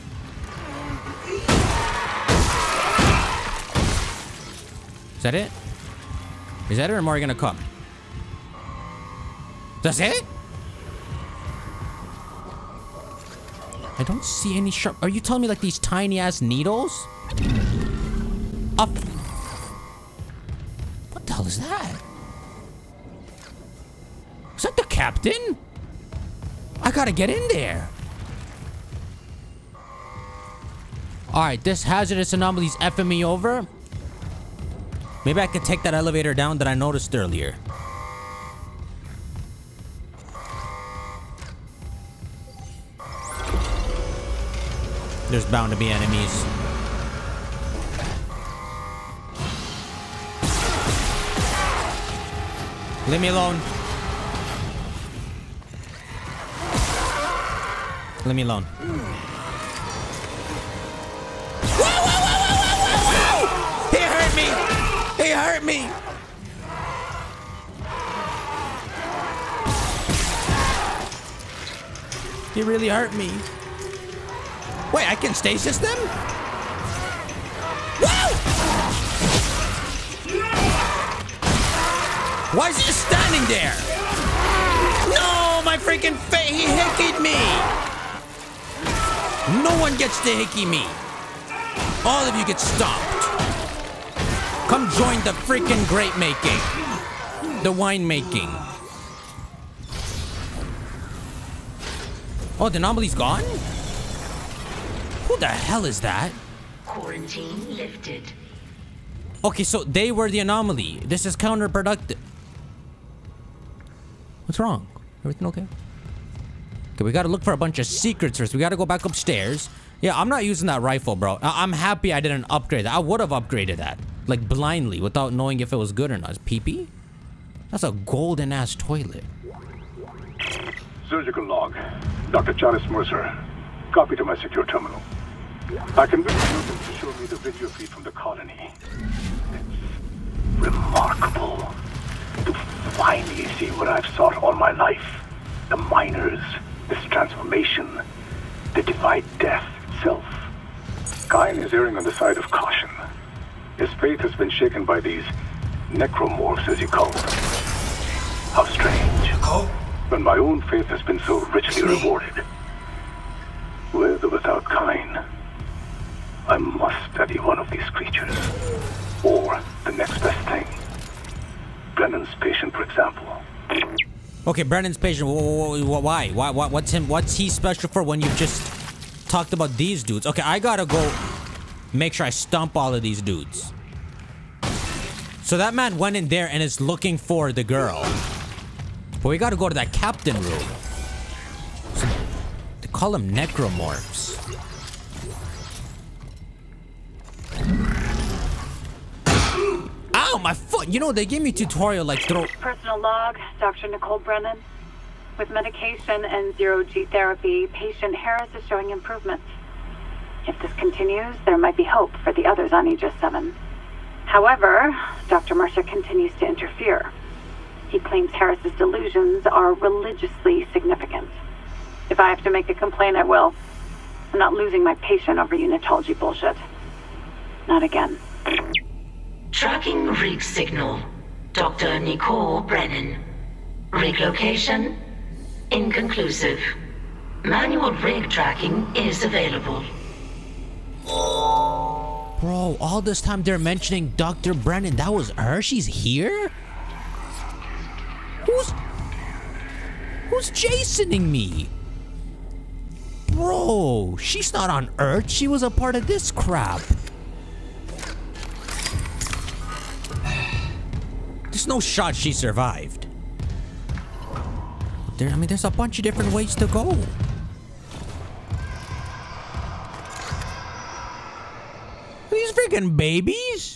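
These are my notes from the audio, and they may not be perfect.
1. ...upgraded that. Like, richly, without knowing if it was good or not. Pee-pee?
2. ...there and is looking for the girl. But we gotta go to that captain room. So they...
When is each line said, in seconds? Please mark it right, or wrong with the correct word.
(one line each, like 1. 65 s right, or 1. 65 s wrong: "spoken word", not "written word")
1. 123 s wrong: "blindly", not "richly"
2. 186 s right.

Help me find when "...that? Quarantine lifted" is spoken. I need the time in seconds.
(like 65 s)
106 s.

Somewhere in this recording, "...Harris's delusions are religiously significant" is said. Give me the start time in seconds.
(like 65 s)
218 s.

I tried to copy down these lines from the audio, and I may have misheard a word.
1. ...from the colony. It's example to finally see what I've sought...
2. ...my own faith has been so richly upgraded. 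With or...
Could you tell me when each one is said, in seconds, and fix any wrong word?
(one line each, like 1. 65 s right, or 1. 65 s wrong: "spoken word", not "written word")
1. 137 s wrong: "remarkable", not "example"
2. 160 s wrong: "rewarded", not "upgraded".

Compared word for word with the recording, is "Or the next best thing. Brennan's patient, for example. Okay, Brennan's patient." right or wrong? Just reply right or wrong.
wrong.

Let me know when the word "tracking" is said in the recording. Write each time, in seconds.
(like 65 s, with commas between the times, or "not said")
229 s, 238 s.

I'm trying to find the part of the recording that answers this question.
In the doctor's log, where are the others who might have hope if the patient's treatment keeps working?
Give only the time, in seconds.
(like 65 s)
212 s.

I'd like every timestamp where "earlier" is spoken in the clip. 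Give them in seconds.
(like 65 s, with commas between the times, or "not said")
37 s.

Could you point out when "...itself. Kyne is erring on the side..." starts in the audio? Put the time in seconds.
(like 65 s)
149 s.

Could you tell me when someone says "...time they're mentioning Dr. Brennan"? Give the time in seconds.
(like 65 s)
243 s.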